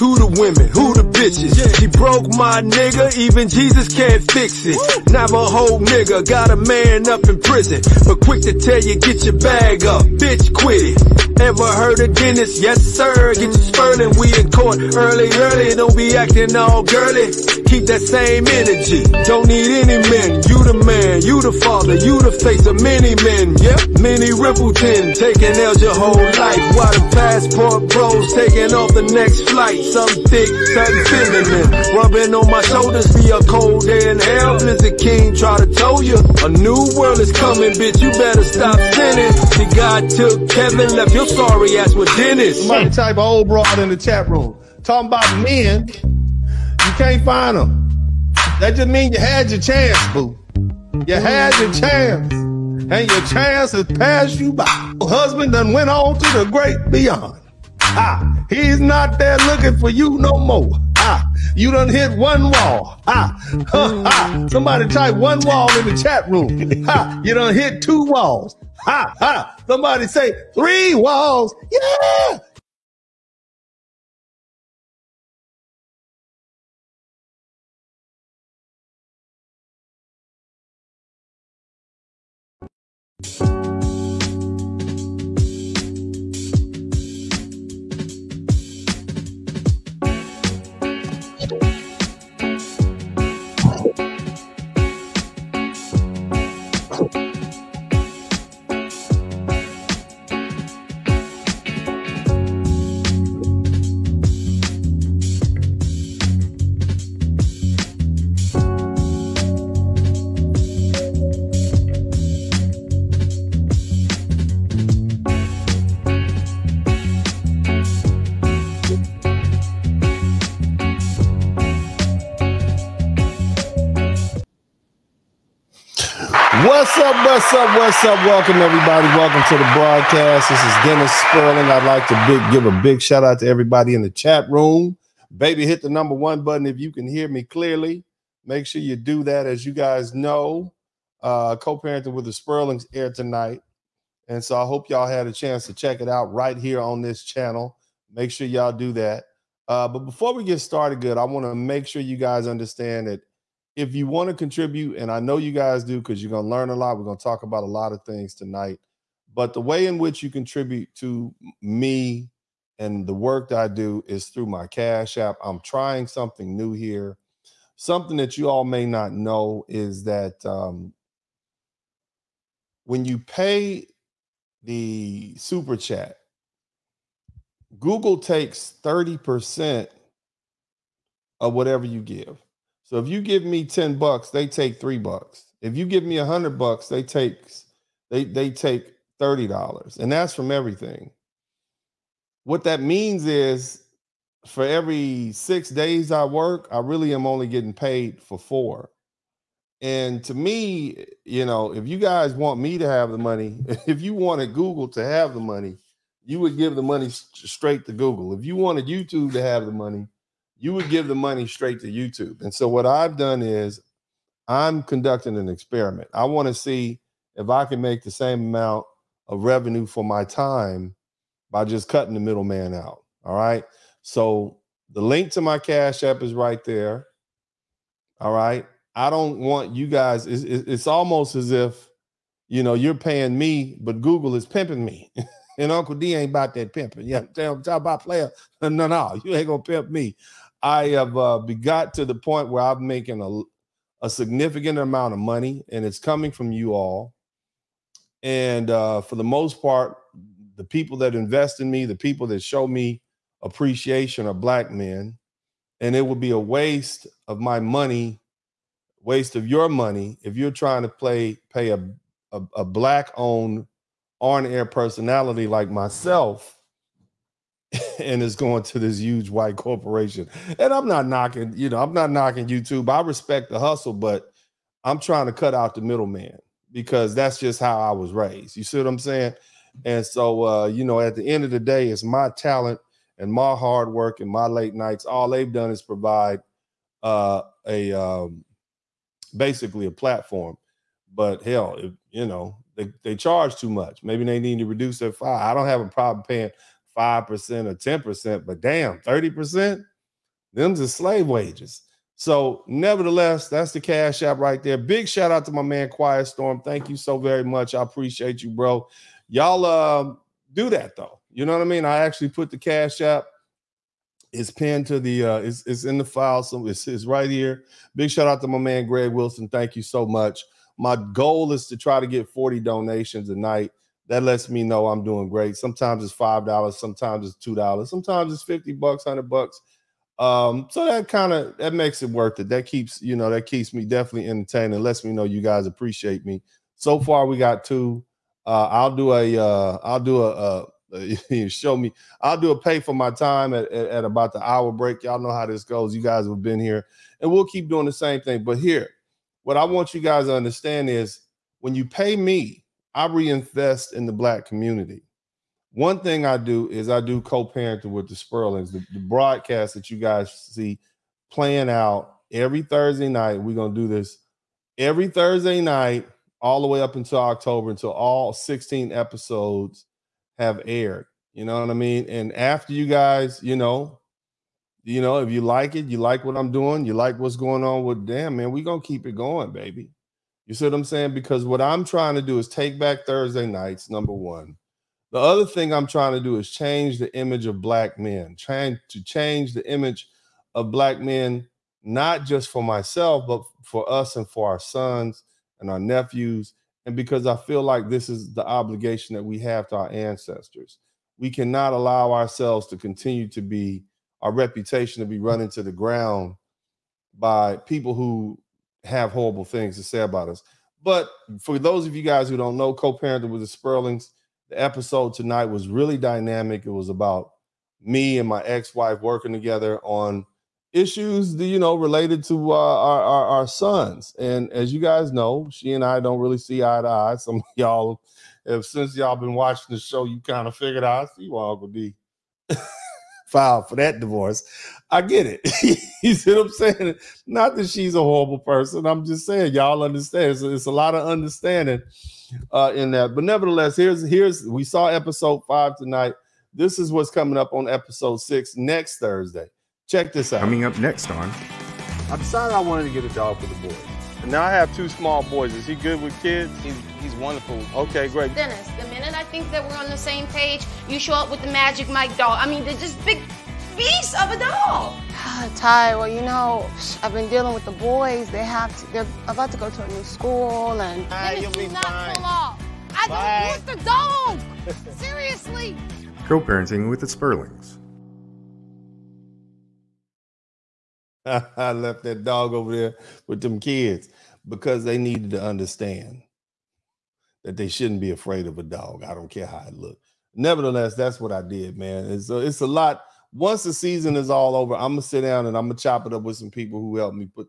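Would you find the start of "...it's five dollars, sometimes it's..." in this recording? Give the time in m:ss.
5:26.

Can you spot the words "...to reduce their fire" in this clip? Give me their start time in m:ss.
4:54.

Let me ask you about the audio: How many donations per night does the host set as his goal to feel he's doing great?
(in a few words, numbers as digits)
40.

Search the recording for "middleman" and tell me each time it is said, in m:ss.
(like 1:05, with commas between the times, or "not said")
3:42, 4:35.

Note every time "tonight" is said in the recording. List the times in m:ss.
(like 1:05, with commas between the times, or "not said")
2:23, 2:38, 6:55, 7:25.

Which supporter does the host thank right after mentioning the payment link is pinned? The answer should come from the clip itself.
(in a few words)
Greg Wilson.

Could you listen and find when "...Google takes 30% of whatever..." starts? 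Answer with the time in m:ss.
2:57.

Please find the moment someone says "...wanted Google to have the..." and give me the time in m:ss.
3:24.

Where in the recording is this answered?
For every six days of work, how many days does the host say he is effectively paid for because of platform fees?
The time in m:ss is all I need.
3:18.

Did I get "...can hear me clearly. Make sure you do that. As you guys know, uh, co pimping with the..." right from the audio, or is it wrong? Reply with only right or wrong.
wrong.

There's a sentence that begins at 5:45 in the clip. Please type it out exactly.
You guys have been here, and we'll keep doing the same thing.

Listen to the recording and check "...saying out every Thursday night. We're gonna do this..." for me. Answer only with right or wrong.
wrong.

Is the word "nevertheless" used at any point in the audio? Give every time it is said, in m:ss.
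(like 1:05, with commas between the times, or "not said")
5:02, 7:23, 8:10.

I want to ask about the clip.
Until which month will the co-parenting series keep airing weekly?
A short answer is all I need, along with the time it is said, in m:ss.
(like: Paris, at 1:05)
October, at 6:07.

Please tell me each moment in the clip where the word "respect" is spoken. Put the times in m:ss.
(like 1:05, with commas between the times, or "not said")
4:33.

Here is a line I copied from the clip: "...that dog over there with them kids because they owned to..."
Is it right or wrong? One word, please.
wrong.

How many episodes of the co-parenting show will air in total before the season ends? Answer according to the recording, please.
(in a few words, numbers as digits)
16.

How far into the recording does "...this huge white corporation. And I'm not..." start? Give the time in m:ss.
4:28.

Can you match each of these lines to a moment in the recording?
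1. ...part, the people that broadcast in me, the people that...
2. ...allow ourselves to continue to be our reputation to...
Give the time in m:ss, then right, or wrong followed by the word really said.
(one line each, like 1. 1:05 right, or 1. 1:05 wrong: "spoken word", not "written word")
1. 4:09 wrong: "invest", not "broadcast"
2. 6:41 right.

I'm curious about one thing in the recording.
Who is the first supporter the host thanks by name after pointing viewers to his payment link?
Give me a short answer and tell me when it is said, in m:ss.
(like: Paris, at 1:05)
Quiet Storm, at 5:05.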